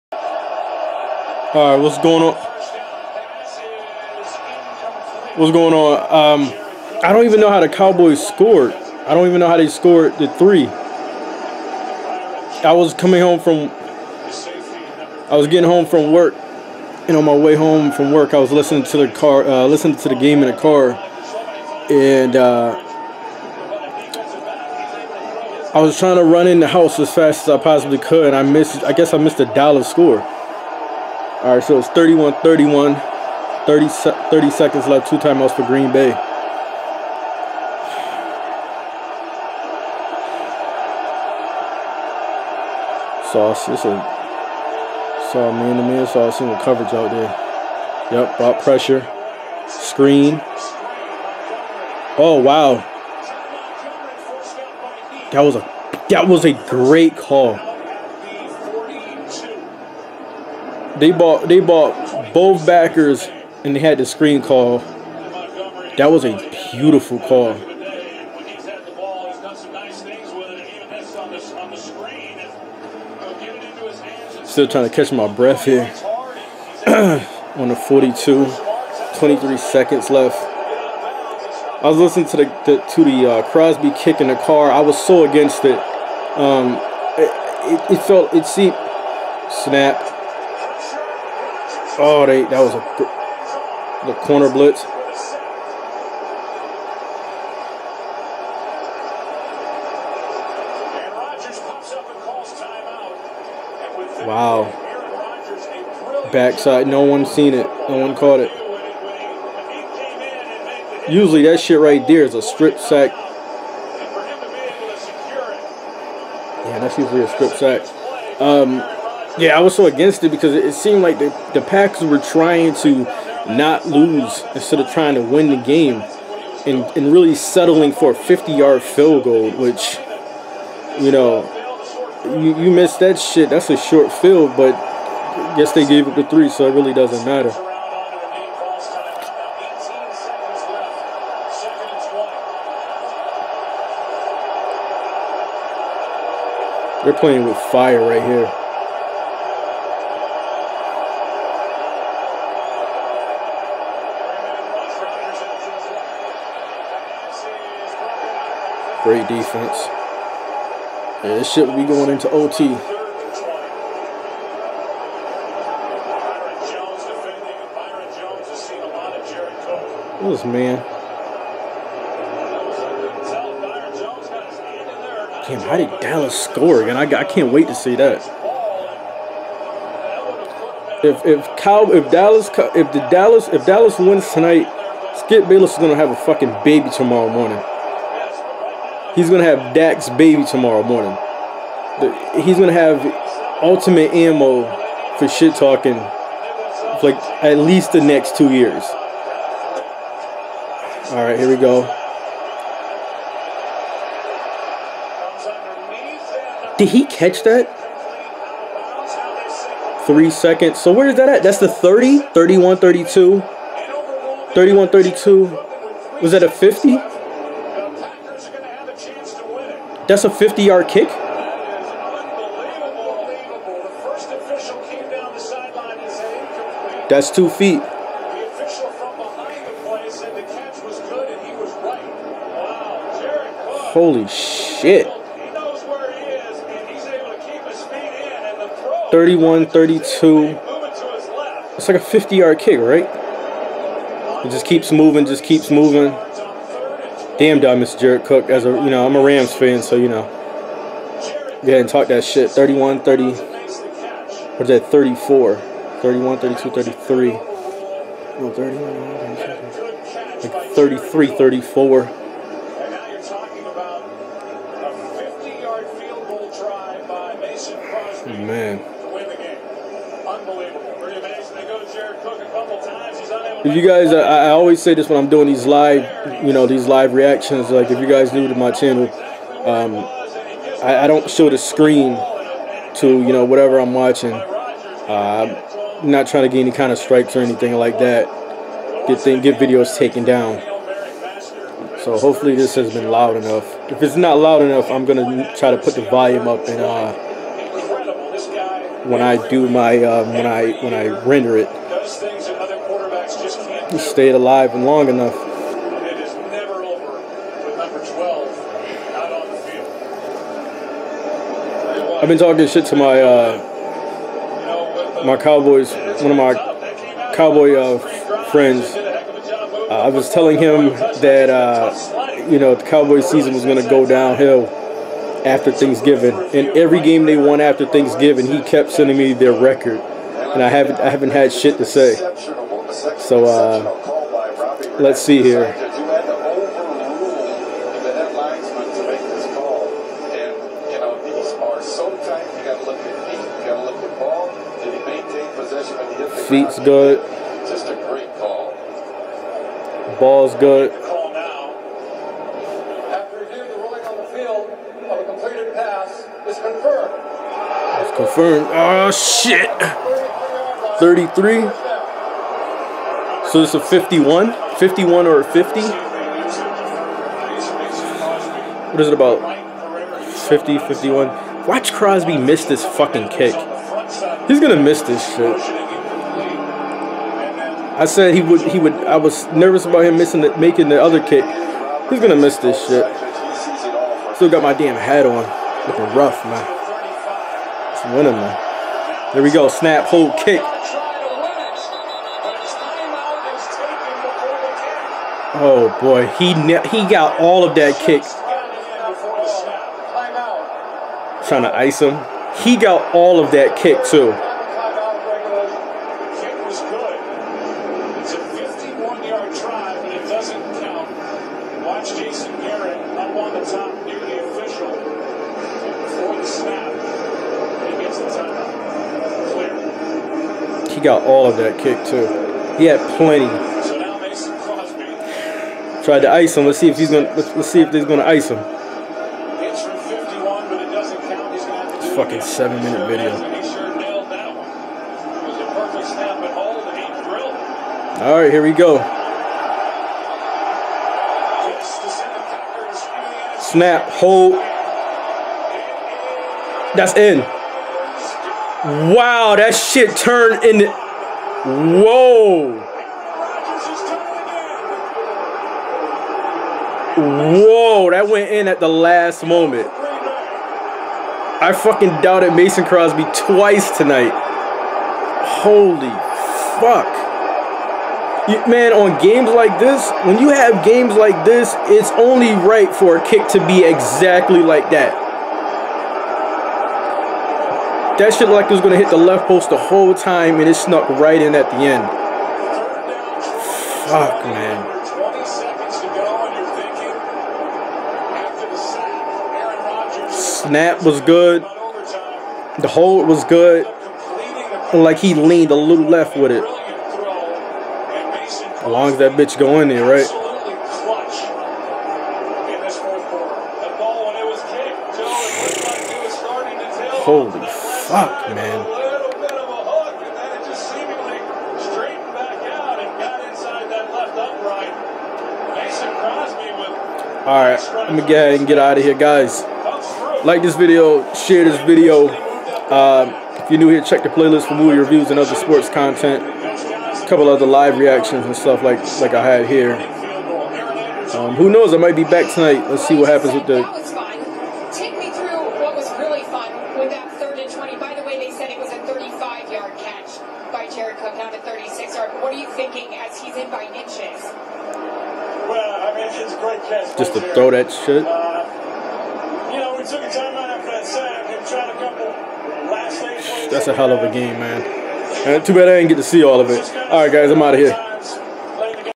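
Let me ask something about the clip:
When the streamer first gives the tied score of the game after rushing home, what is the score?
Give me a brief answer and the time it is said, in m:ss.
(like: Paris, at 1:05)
31-31, at 0:31.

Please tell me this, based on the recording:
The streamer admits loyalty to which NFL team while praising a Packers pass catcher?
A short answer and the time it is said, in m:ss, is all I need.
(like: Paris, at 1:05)
Rams, at 4:09.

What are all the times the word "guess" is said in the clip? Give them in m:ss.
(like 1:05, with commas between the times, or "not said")
0:28, 2:15.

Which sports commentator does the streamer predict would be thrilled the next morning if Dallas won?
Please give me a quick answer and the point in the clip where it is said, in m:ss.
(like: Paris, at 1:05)
Skip Bayless, at 3:05.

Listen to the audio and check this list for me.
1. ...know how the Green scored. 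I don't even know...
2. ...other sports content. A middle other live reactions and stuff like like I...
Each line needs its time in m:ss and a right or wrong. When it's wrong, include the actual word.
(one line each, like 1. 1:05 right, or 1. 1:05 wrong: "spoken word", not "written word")
1. 0:07 wrong: "Cowboys", not "Green"
2. 8:45 wrong: "couple", not "middle".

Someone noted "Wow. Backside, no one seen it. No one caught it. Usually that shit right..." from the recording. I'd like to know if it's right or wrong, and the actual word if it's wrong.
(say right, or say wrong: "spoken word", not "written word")
right.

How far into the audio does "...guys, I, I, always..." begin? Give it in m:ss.
4:33.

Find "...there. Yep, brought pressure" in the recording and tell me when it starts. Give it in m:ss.
0:47.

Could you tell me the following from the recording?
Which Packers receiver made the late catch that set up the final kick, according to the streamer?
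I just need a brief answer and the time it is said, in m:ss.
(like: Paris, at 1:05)
Jared Cook, at 4:07.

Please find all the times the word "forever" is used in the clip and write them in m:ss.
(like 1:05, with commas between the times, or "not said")
not said.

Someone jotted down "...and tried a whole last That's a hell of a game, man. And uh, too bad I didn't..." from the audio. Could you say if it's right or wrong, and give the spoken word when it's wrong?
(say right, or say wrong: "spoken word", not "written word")
wrong: "couple", not "whole".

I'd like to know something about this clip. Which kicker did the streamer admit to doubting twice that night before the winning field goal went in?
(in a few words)
Mason Crosby.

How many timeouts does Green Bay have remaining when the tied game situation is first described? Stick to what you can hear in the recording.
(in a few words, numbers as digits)
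2.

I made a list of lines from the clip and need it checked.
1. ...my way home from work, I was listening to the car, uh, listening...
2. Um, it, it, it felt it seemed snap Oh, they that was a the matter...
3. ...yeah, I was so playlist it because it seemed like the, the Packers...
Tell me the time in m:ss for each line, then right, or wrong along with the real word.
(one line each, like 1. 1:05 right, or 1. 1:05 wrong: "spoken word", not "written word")
1. 0:17 right
2. 1:26 wrong: "corner", not "matter"
3. 1:59 wrong: "against", not "playlist".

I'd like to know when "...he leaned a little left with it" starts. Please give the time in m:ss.
8:15.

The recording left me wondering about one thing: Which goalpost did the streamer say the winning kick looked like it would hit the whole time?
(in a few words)
Left post.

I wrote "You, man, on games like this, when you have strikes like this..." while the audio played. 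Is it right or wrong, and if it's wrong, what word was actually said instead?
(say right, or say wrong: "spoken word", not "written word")
wrong: "games", not "strikes".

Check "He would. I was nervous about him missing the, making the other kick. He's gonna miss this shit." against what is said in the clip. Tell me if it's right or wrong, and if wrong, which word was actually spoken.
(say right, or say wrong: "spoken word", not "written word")
right.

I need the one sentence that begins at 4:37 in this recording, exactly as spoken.
Like, if you guys new to my channel, um, I, I, don't show the screen to, you know, whatever I'm watching.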